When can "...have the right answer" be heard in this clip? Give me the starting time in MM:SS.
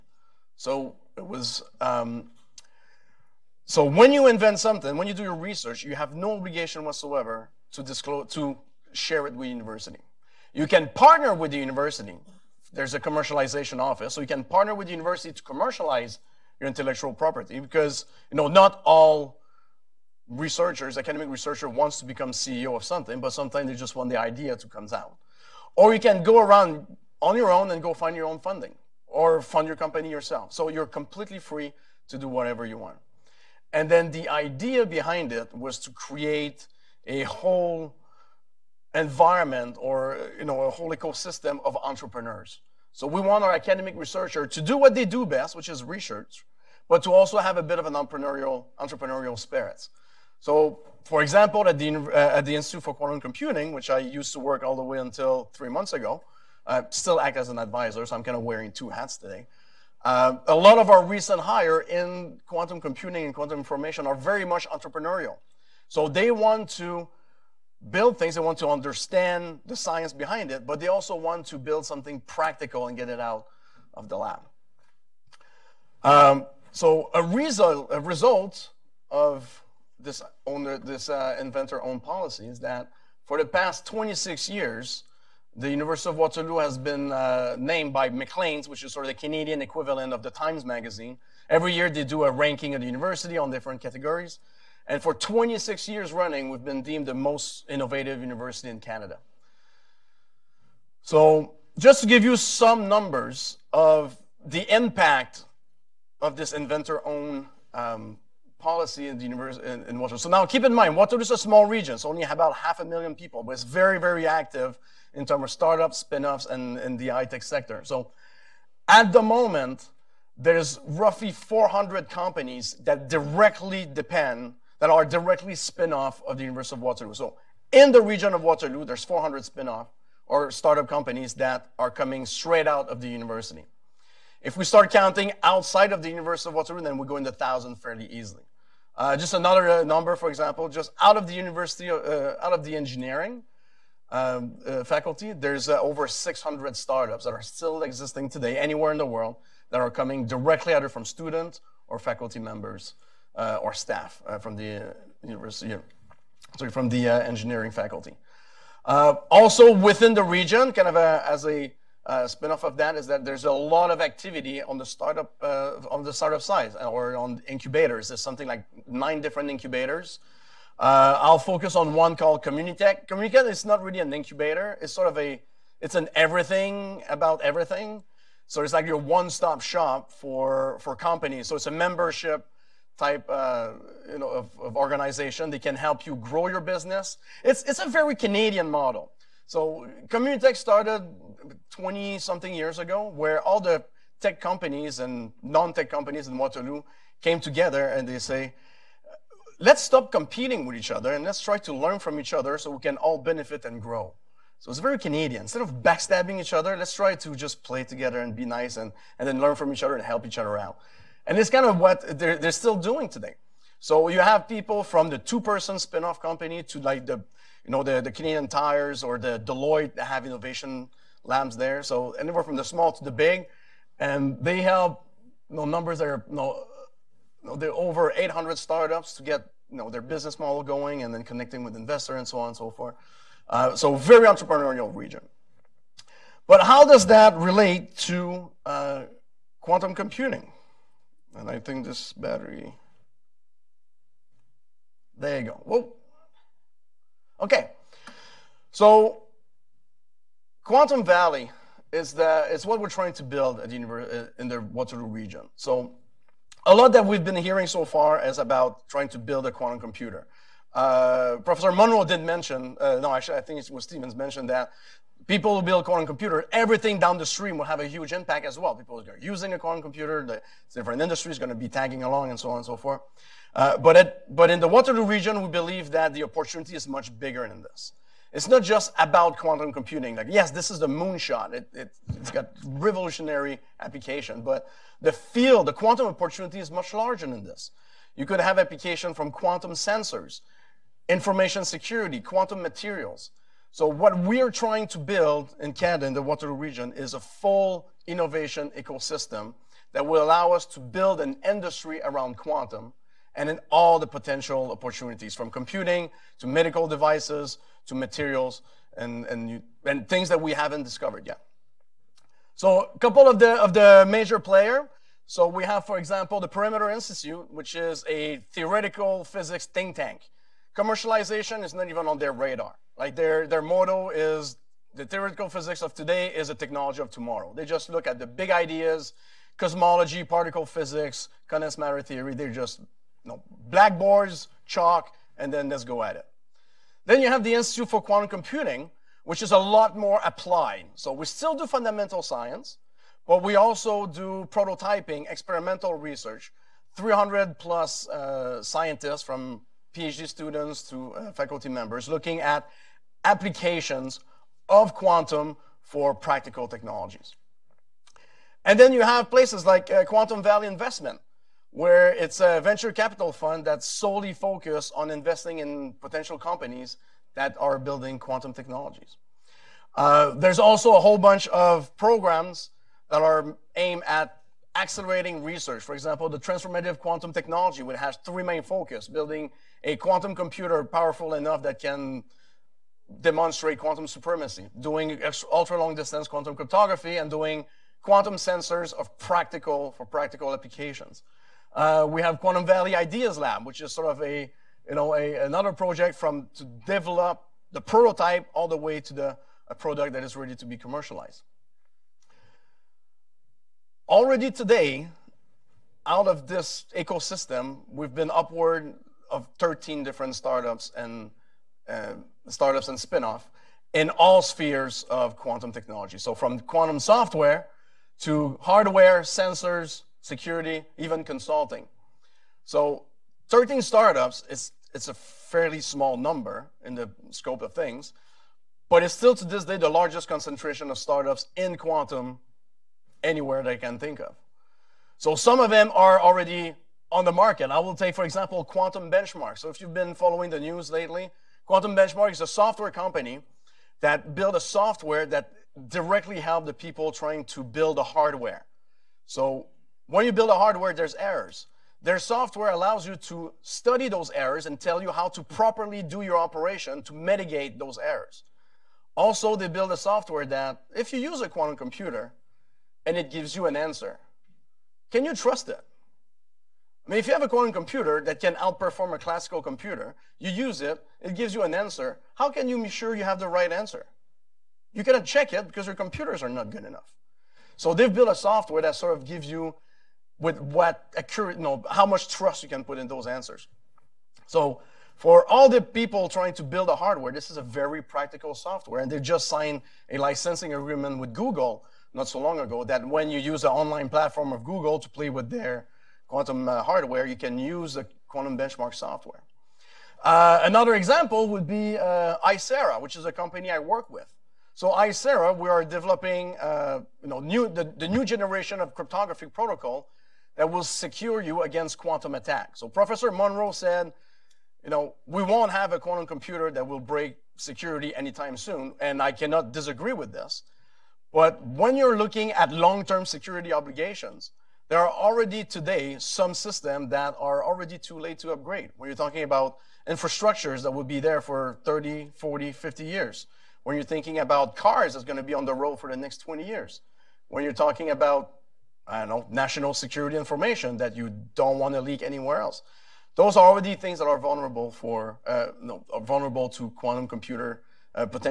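07:53.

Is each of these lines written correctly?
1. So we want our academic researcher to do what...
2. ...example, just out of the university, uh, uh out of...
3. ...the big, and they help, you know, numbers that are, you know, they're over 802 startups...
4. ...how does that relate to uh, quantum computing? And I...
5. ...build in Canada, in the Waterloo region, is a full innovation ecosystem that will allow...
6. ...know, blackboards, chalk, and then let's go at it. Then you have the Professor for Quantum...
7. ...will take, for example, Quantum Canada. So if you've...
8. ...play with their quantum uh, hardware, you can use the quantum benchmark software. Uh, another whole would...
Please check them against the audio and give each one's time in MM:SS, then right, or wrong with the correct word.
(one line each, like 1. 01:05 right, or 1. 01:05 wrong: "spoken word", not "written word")
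1. 00:42 right
2. 02:20 right
3. 03:43 wrong: "800", not "802"
4. 03:56 right
5. 04:54 right
6. 05:33 wrong: "Institute", not "Professor"
7. 07:17 wrong: "Benchmark", not "Canada"
8. 08:15 wrong: "example", not "whole".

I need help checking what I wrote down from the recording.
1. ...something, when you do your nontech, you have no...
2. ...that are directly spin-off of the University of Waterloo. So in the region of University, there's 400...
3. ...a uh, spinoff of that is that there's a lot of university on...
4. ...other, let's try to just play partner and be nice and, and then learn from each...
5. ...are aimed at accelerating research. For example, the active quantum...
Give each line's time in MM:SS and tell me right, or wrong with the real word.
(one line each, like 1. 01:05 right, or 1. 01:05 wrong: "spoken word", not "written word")
1. 00:04 wrong: "research", not "nontech"
2. 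02:04 wrong: "Waterloo", not "University"
3. 02:41 wrong: "activity", not "university"
4. 03:26 wrong: "together", not "partner"
5. 06:13 wrong: "transformative", not "active".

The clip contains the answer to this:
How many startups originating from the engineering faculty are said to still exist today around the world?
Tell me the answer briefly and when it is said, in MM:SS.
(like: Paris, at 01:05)
over 600, at 02:25.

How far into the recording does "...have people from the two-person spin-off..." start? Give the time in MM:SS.
03:34.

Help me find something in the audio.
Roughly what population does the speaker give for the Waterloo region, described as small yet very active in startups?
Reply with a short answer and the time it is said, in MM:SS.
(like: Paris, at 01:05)
half a million, at 01:52.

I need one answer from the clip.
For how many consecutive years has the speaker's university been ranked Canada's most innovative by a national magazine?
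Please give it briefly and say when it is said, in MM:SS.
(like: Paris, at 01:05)
26, at 01:35.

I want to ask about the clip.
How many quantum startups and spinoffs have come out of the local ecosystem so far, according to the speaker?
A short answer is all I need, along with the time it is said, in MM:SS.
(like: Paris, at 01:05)
13, at 06:49.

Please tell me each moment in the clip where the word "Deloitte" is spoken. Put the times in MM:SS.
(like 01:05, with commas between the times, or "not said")
03:39.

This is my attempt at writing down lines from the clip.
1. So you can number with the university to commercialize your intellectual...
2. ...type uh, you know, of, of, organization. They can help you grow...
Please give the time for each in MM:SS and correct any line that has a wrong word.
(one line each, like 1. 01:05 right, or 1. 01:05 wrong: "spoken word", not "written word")
1. 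00:14 wrong: "partner", not "number"
2. 03:03 right.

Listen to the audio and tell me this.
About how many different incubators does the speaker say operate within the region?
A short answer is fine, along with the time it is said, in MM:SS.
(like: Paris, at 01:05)
9, at 02:48.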